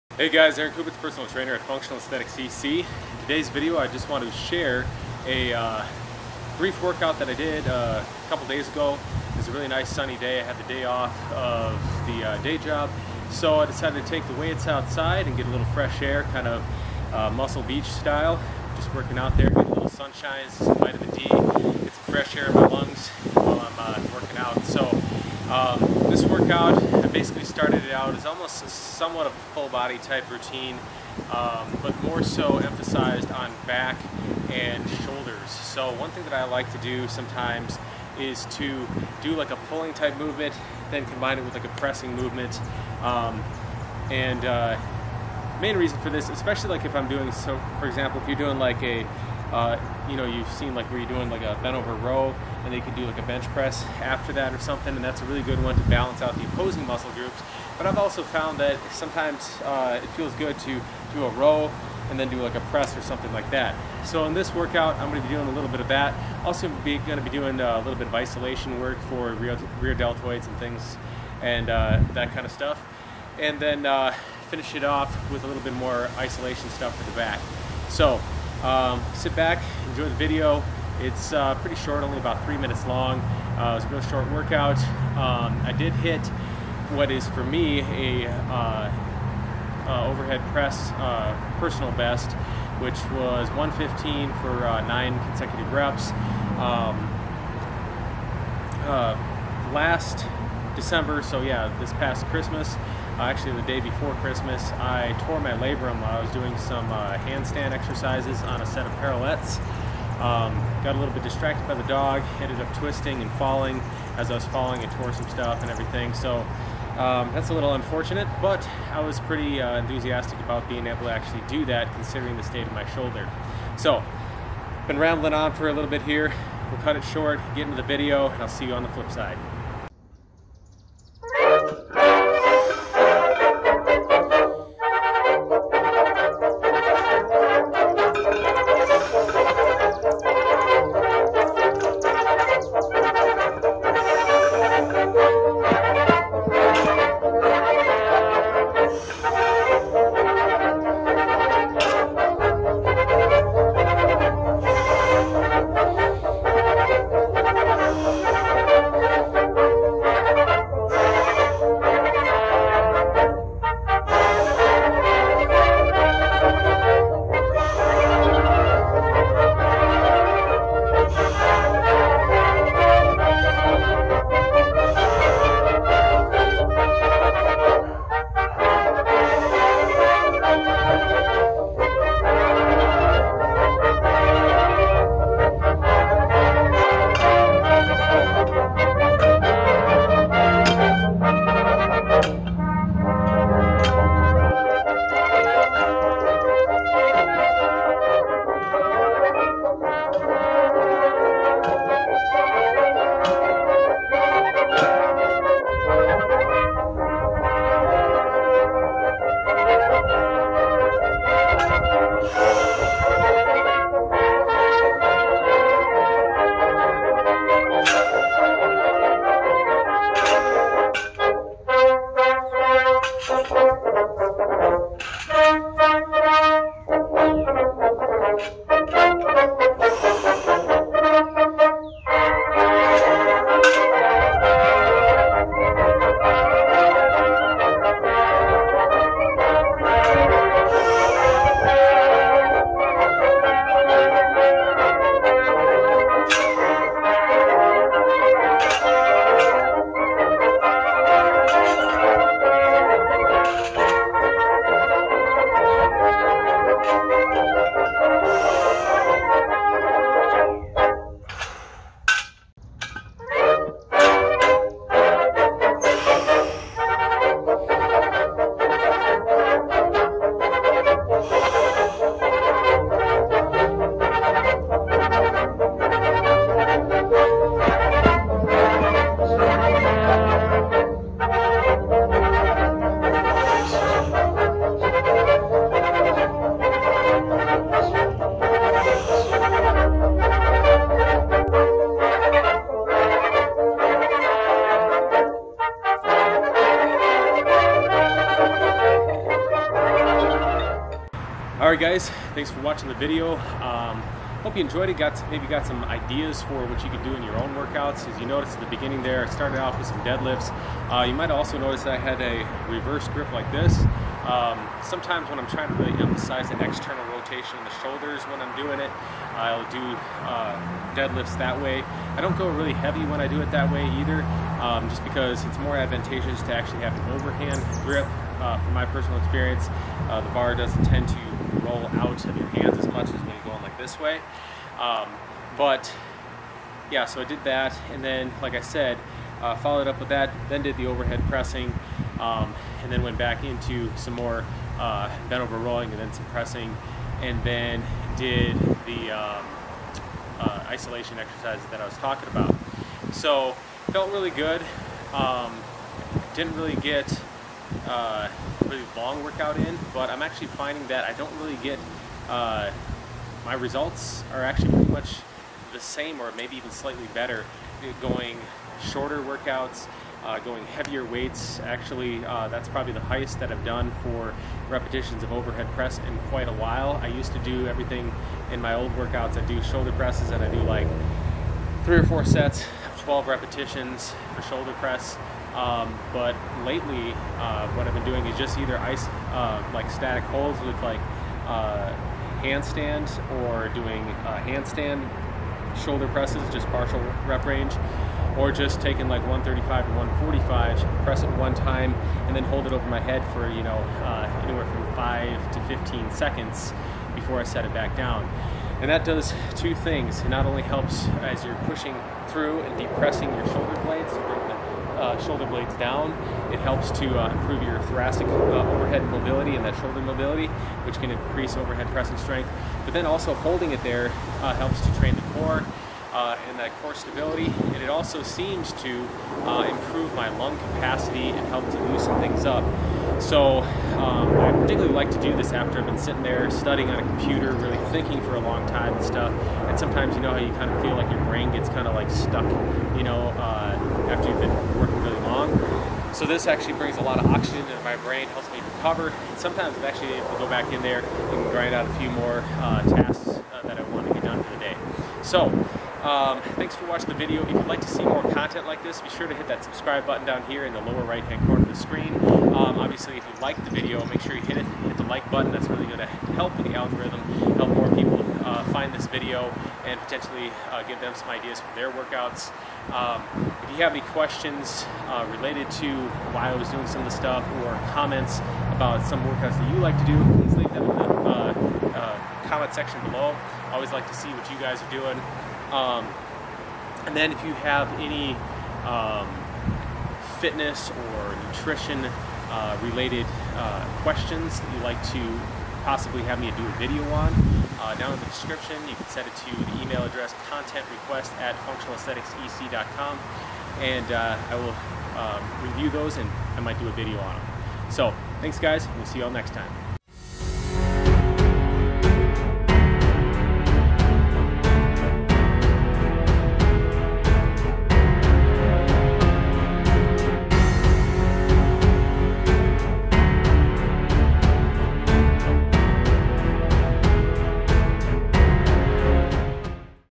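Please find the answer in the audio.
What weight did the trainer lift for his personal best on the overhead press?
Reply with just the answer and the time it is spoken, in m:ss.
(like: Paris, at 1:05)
115, at 1:33.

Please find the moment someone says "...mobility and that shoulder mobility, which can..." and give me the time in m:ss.
6:59.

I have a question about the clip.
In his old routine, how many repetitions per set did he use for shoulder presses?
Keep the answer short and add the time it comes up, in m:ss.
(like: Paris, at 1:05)
12, at 6:23.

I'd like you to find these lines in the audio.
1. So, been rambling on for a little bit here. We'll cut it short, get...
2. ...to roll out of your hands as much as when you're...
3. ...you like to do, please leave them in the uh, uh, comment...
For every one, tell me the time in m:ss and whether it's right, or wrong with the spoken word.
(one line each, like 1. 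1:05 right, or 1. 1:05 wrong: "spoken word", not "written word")
1. 2:03 right
2. 5:31 right
3. 7:59 right.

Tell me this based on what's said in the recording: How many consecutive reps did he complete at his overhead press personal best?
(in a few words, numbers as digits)
9.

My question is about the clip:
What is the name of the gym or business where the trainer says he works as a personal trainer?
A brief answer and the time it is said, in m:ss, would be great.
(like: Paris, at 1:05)
Functional Aesthetics EC, at 0:01.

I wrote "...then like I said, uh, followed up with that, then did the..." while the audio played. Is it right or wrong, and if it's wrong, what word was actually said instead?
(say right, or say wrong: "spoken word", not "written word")
right.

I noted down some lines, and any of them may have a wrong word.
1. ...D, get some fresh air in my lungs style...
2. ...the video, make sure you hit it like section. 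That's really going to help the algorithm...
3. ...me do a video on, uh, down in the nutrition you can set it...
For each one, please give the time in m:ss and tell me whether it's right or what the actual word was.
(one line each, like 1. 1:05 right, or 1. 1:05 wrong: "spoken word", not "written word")
1. 0:21 wrong: "while", not "style"
2. 7:43 wrong: "button", not "section"
3. 8:16 wrong: "description", not "nutrition".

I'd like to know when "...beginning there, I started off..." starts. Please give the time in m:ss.
5:08.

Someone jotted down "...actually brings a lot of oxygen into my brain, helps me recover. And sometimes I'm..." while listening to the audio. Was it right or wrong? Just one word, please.
right.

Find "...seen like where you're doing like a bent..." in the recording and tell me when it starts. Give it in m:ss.
0:50.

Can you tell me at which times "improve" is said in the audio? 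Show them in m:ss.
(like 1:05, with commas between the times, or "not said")
6:57, 7:09.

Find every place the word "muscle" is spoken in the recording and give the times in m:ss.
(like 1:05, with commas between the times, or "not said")
0:17, 0:56.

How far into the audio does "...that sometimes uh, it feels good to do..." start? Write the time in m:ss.
0:58.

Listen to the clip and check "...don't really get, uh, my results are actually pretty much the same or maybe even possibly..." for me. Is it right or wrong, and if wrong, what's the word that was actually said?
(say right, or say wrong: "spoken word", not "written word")
wrong: "slightly", not "possibly".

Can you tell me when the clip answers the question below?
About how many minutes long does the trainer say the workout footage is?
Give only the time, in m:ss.
1:22.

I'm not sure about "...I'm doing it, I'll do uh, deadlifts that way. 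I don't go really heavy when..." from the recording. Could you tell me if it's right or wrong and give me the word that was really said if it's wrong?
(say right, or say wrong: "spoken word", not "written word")
right.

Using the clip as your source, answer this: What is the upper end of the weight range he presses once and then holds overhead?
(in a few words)
145.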